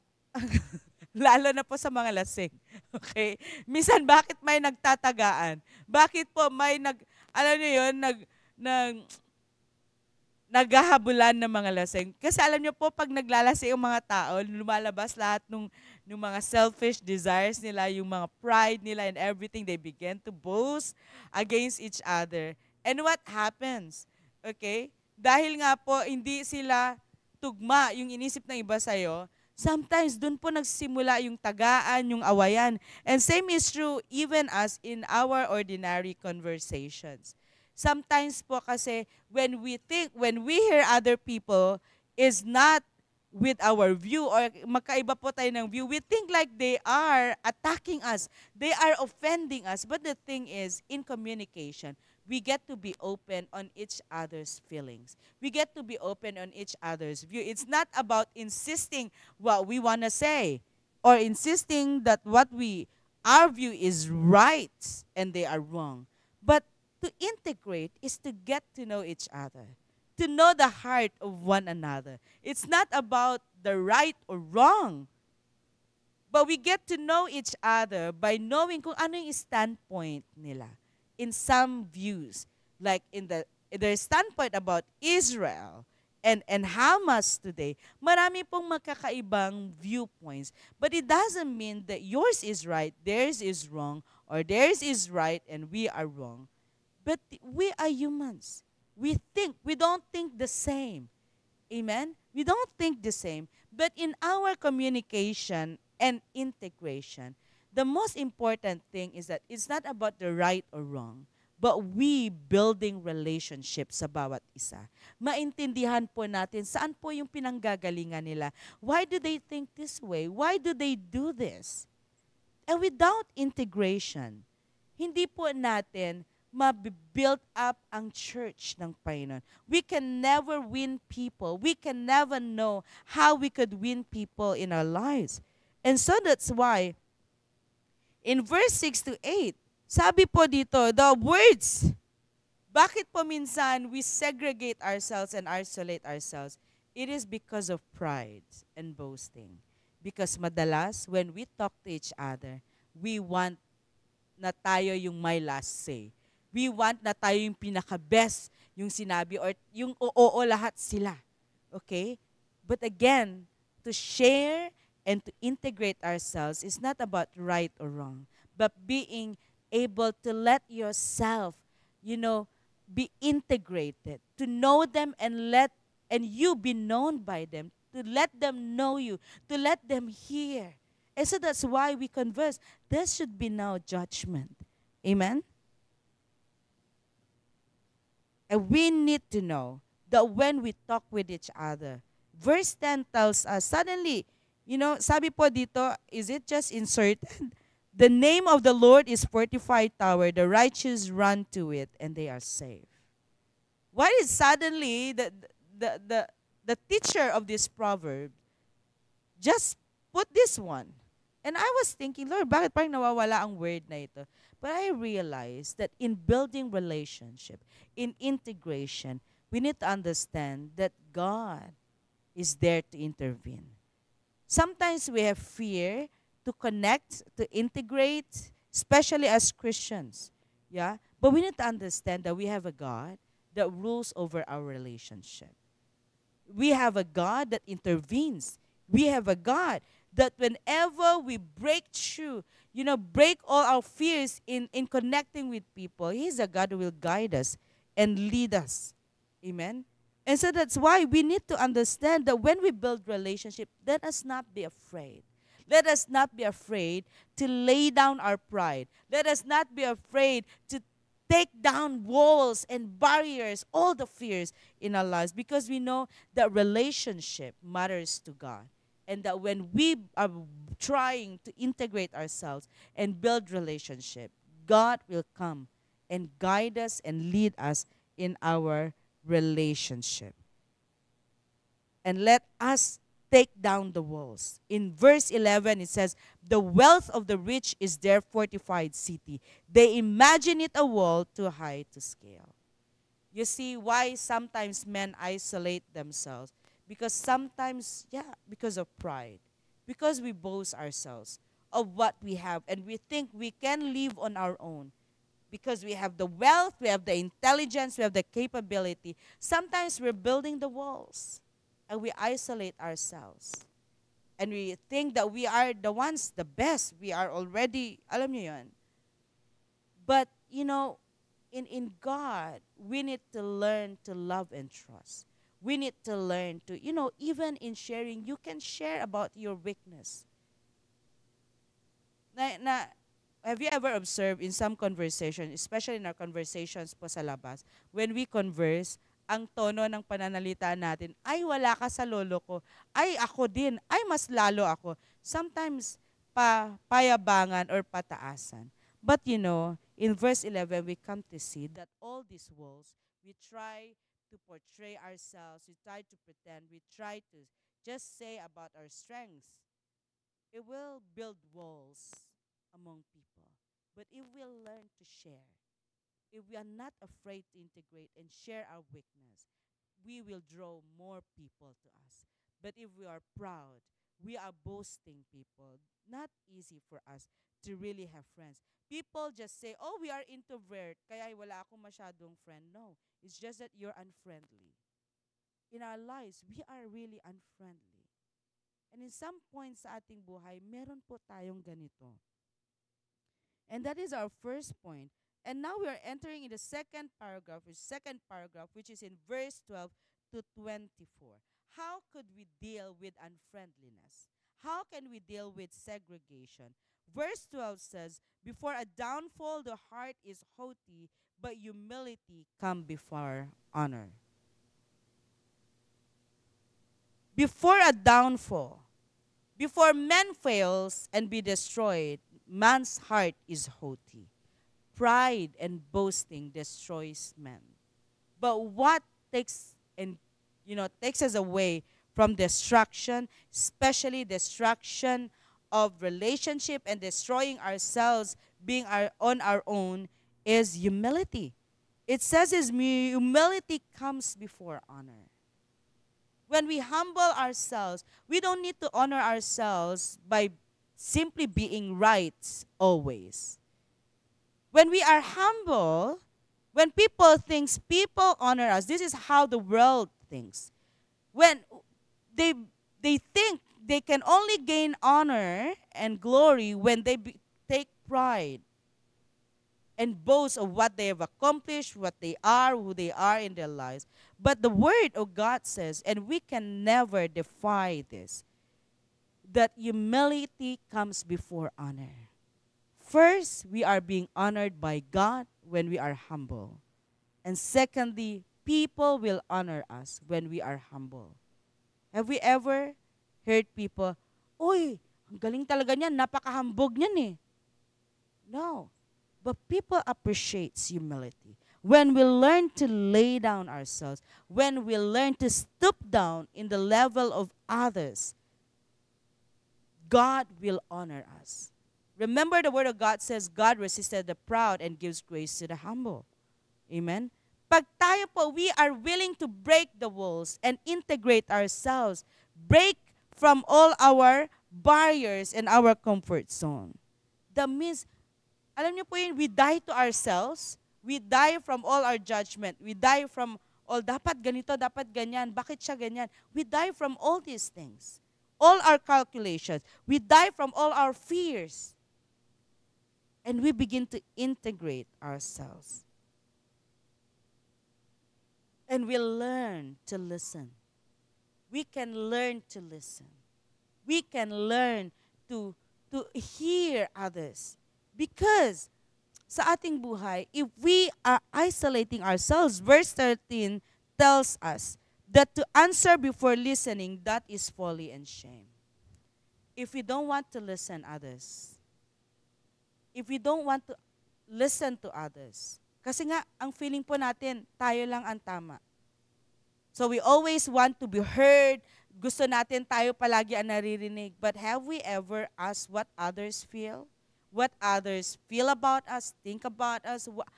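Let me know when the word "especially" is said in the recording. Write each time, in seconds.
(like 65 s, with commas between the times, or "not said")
228 s, 335 s, 433 s.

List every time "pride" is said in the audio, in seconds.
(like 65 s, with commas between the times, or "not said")
18 s, 147 s, 258 s, 298 s, 424 s, 468 s.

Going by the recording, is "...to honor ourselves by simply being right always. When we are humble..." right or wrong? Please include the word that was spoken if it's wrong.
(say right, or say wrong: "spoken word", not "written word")
right.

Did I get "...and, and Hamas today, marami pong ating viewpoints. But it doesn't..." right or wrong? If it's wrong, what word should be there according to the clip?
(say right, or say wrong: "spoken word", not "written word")
wrong: "magkakaibang", not "ating".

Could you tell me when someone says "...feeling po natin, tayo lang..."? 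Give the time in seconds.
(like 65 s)
576 s.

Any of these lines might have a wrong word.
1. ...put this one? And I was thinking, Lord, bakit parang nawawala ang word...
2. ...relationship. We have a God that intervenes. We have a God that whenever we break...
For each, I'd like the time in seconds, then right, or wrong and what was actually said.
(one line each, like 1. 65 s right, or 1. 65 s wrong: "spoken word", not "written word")
1. 210 s right
2. 234 s right.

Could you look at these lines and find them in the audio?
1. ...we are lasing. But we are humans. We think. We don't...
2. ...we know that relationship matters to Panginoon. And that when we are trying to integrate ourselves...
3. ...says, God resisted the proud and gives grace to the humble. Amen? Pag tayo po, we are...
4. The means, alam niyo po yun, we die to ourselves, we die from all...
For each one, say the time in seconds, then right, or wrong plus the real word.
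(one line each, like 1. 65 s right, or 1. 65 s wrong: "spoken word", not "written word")
1. 95 s wrong: "wrong", not "lasing"
2. 265 s wrong: "God", not "Panginoon"
3. 513 s right
4. 527 s right.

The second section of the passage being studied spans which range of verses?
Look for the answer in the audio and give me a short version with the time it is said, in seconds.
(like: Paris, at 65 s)
12 to 24, at 399 s.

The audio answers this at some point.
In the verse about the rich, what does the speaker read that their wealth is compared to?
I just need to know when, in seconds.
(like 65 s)
288 s.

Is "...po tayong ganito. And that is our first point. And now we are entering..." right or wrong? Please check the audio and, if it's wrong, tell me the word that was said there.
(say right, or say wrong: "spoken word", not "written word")
right.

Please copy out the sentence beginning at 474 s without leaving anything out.
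But the Word of God says, and we can never defy this that humility comes before honor.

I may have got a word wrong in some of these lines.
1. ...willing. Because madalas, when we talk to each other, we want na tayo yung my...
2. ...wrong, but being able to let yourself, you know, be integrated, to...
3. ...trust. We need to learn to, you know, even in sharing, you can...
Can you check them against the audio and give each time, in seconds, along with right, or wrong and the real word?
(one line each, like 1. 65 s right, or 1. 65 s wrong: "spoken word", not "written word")
1. 148 s wrong: "boasting", not "willing"
2. 167 s right
3. 324 s right.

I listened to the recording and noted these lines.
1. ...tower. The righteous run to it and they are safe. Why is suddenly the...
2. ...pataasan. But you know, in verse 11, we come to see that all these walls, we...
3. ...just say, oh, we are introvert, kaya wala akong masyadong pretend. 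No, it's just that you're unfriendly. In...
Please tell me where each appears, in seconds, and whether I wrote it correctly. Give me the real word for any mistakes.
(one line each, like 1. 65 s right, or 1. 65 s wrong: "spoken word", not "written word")
1. 199 s right
2. 347 s right
3. 379 s wrong: "friend", not "pretend".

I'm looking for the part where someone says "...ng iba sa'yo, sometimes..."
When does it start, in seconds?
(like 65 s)
28 s.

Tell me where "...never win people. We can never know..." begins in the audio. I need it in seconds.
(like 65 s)
130 s.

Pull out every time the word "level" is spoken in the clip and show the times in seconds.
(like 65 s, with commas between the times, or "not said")
506 s.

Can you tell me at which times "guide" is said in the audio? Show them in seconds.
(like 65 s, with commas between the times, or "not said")
246 s, 276 s.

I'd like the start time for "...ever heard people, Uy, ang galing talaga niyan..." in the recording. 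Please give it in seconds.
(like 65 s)
492 s.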